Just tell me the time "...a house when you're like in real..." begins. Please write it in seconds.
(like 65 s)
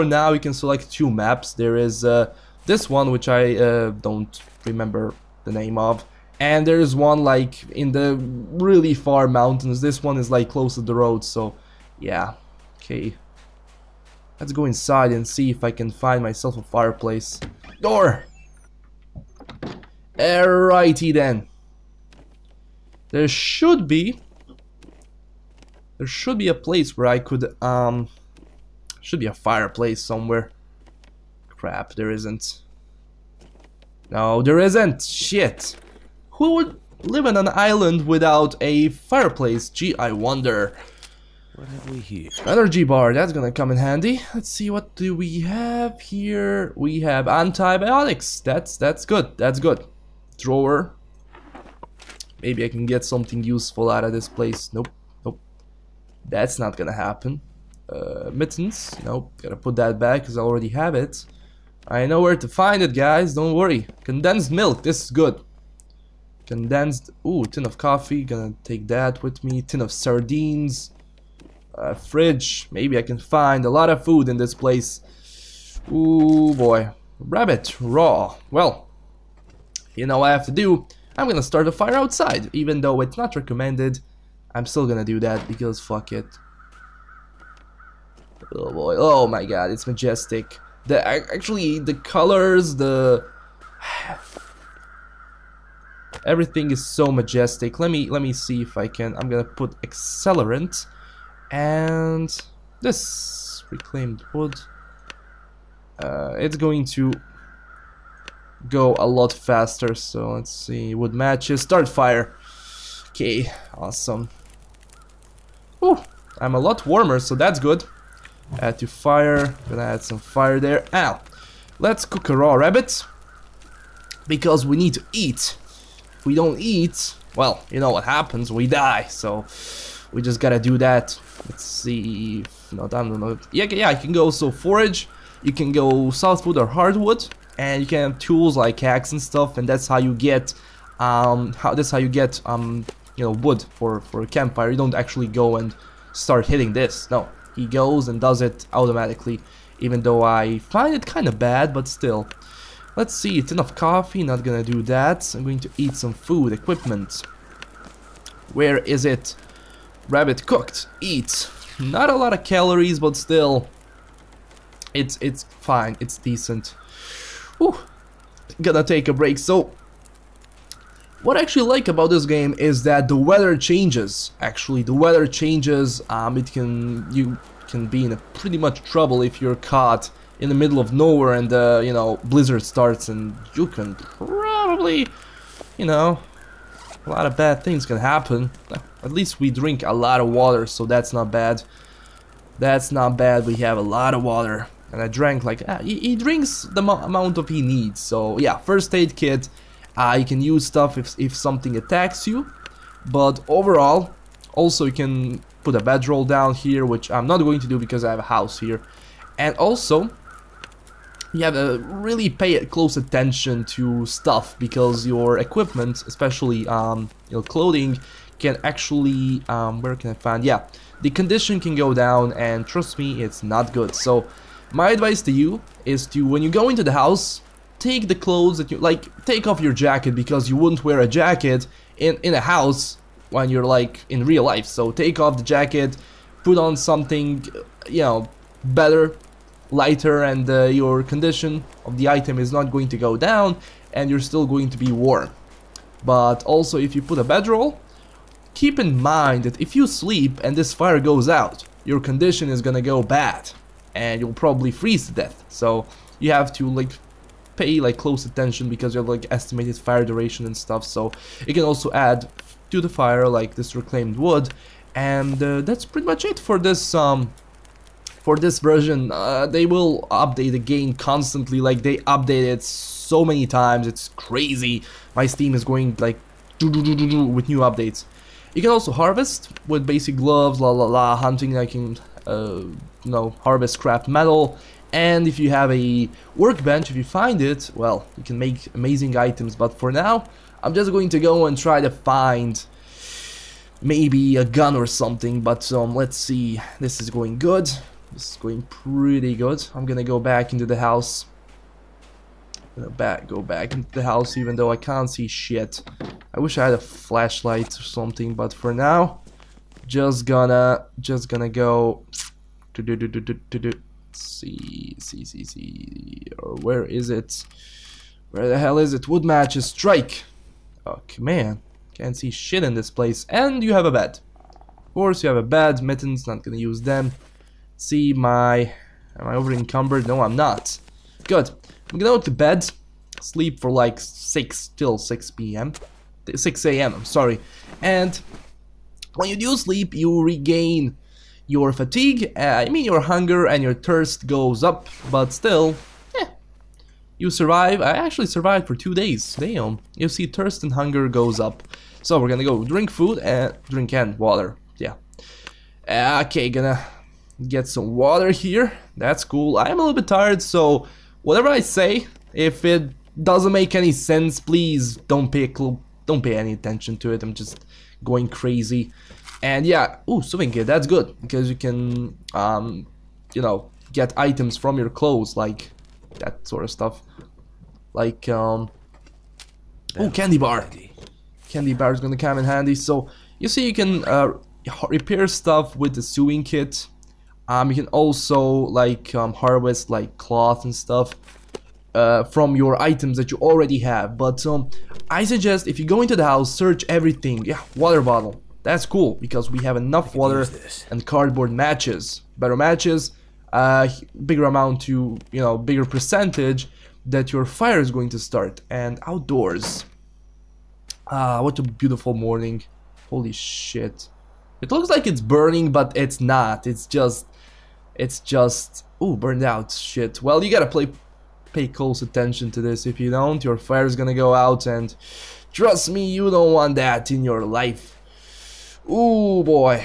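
232 s.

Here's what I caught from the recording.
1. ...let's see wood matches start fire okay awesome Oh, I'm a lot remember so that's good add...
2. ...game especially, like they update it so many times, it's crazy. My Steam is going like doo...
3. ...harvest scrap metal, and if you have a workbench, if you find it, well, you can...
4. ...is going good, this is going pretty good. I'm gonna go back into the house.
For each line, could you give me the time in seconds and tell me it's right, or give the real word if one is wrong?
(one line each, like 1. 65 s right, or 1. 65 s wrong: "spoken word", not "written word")
1. 110 s wrong: "warmer", not "remember"
2. 270 s wrong: "constantly", not "especially"
3. 283 s right
4. 297 s right.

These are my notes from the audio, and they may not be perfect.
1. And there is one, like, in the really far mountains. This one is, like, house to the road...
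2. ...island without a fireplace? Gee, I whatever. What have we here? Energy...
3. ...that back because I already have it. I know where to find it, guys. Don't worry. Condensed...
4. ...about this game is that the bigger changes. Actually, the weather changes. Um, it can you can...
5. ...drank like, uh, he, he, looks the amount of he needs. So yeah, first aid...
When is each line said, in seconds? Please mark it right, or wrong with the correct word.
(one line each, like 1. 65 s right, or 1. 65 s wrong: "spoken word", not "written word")
1. 6 s wrong: "close", not "house"
2. 37 s wrong: "wonder", not "whatever"
3. 59 s right
4. 171 s wrong: "weather", not "bigger"
5. 195 s wrong: "drinks", not "looks".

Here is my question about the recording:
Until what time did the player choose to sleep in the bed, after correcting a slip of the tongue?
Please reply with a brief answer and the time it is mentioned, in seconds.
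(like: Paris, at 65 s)
6 a.m., at 336 s.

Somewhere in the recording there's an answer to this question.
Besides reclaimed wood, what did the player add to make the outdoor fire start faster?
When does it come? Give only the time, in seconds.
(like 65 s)
99 s.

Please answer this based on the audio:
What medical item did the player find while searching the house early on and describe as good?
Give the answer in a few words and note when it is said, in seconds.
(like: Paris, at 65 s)
Antibiotics, at 47 s.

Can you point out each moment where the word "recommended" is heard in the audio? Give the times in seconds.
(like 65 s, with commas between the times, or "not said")
83 s.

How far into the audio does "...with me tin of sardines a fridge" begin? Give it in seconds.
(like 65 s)
69 s.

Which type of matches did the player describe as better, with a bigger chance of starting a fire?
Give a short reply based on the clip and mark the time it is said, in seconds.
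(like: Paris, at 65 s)
Cardboard matches, at 401 s.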